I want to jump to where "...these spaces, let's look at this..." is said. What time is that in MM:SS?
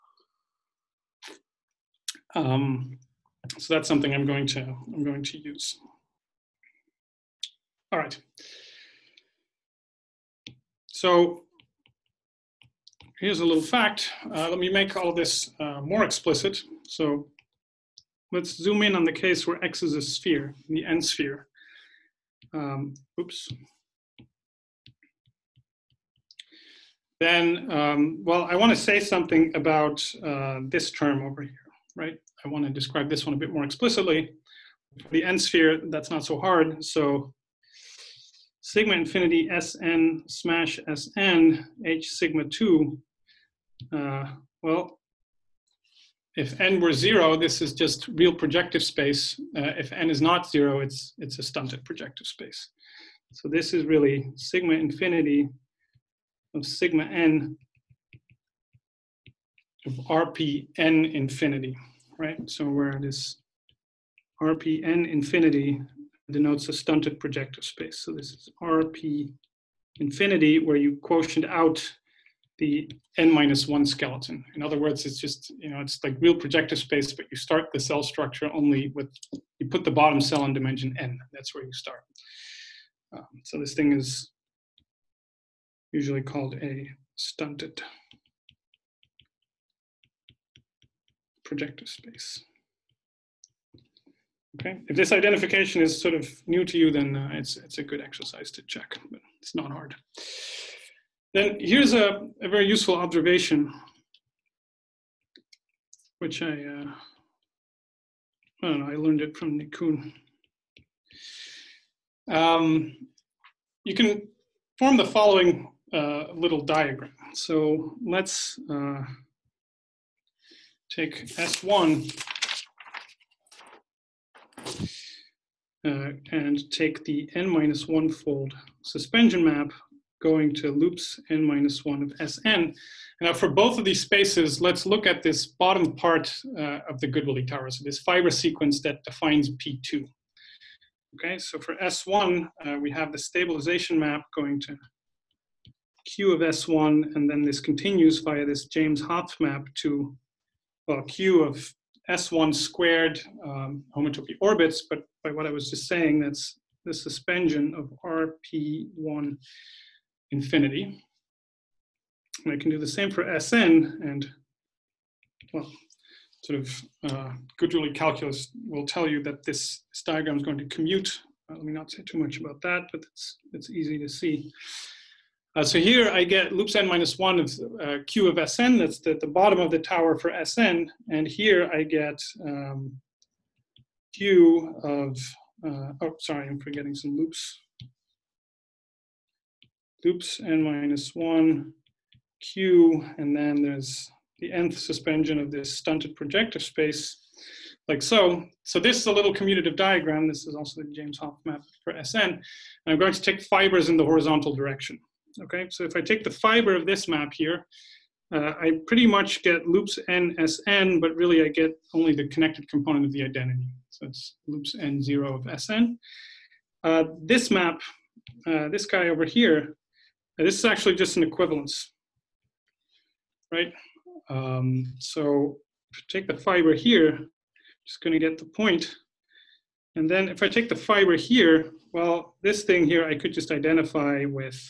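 02:13.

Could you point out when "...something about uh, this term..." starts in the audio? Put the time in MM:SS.
00:28.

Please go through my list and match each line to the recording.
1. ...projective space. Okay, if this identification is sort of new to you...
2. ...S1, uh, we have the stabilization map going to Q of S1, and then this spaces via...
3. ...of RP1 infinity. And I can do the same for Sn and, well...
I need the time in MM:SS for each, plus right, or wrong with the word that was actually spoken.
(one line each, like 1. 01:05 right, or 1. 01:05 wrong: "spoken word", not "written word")
1. 01:31 right
2. 02:21 wrong: "continues", not "spaces"
3. 02:37 right.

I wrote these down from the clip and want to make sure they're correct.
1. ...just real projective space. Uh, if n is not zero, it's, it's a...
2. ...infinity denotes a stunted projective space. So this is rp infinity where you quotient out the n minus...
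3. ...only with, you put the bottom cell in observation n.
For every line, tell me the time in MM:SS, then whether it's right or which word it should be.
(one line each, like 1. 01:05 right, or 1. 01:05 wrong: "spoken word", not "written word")
1. 00:47 right
2. 01:05 right
3. 01:18 wrong: "dimension", not "observation".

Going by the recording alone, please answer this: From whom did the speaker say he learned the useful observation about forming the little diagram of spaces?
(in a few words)
Nick Kuhn.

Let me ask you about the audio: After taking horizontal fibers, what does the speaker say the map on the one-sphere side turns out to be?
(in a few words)
An equivalence.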